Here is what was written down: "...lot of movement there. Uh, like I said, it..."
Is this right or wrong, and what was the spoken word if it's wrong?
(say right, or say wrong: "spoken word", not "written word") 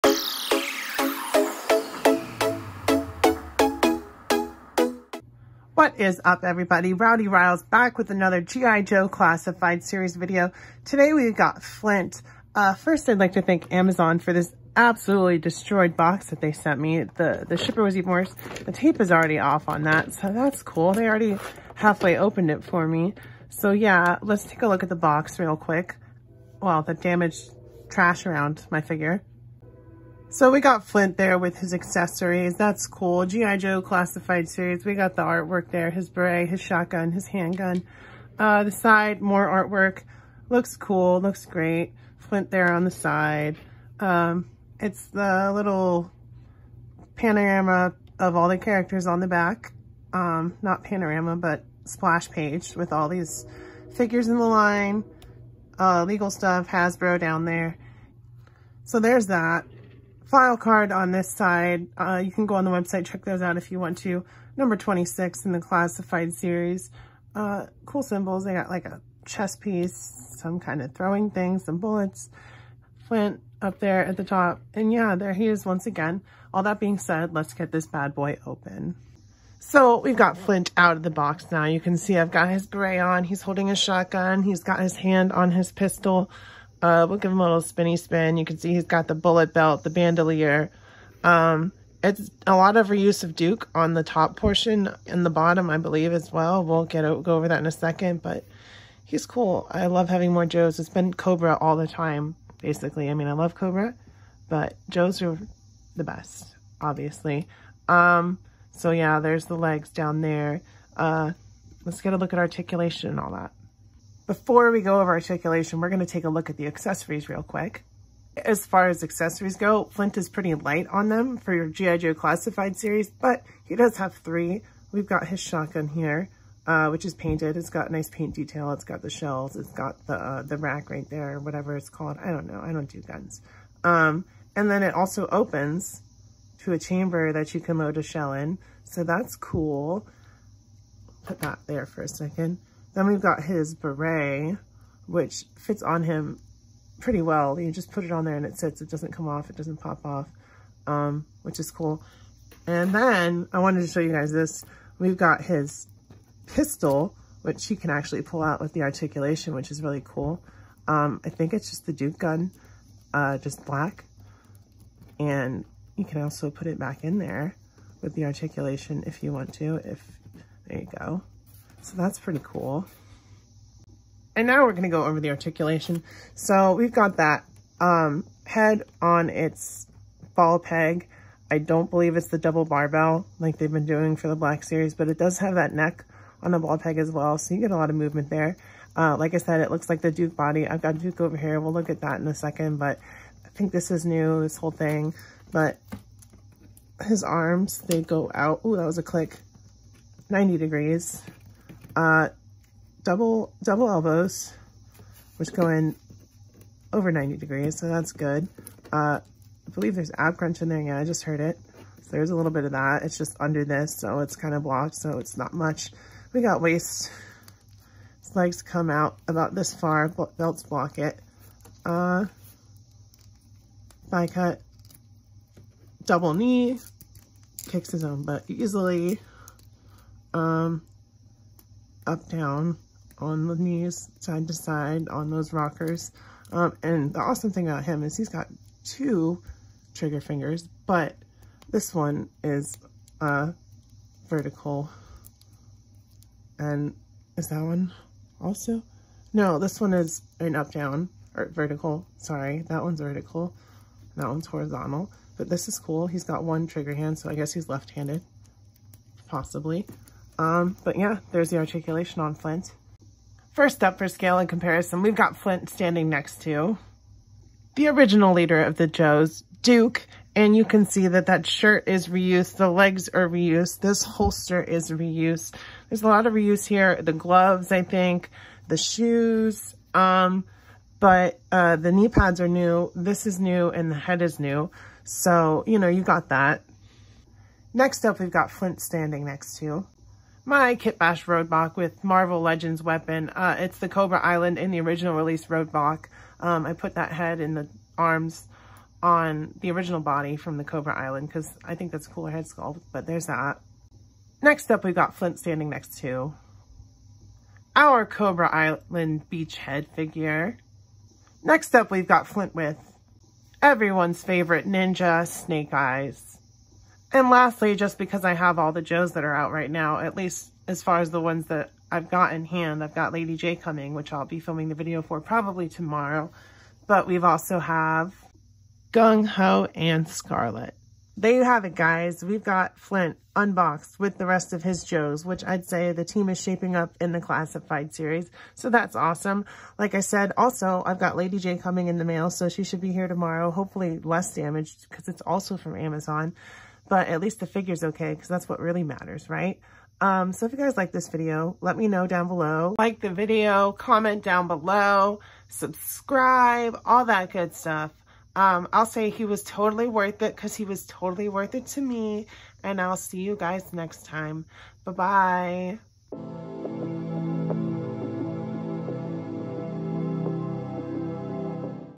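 right.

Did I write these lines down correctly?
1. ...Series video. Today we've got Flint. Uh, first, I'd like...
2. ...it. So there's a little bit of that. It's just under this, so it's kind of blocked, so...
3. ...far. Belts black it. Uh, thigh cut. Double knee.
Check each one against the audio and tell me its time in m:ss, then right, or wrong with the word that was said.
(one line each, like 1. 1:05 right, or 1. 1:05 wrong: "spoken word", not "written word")
1. 0:09 right
2. 3:31 right
3. 3:39 wrong: "block", not "black".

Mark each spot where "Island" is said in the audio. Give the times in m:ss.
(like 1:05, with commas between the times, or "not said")
4:54, 5:00, 5:08.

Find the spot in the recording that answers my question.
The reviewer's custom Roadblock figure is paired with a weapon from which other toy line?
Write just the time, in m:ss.
4:52.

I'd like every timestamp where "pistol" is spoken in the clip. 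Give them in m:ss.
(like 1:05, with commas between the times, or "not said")
1:25, 2:36.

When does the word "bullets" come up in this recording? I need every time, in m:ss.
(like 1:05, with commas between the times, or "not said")
1:11, 1:29.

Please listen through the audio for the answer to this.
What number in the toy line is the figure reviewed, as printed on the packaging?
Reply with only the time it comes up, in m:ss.
1:04.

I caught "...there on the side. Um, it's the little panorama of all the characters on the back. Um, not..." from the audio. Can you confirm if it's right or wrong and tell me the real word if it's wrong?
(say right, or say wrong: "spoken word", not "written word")
right.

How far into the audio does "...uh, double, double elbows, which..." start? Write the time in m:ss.
3:21.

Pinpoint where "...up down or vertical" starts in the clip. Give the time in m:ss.
4:10.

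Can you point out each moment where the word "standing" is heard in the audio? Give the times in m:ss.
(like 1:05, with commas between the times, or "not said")
4:25, 4:48, 5:05.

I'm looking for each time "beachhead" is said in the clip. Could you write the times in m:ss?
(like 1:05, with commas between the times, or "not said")
5:09.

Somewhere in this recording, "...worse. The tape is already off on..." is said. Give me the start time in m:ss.
0:18.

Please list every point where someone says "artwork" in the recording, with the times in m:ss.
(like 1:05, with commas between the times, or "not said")
0:35, 0:39.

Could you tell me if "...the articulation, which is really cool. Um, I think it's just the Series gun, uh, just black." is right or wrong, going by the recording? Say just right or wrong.
wrong.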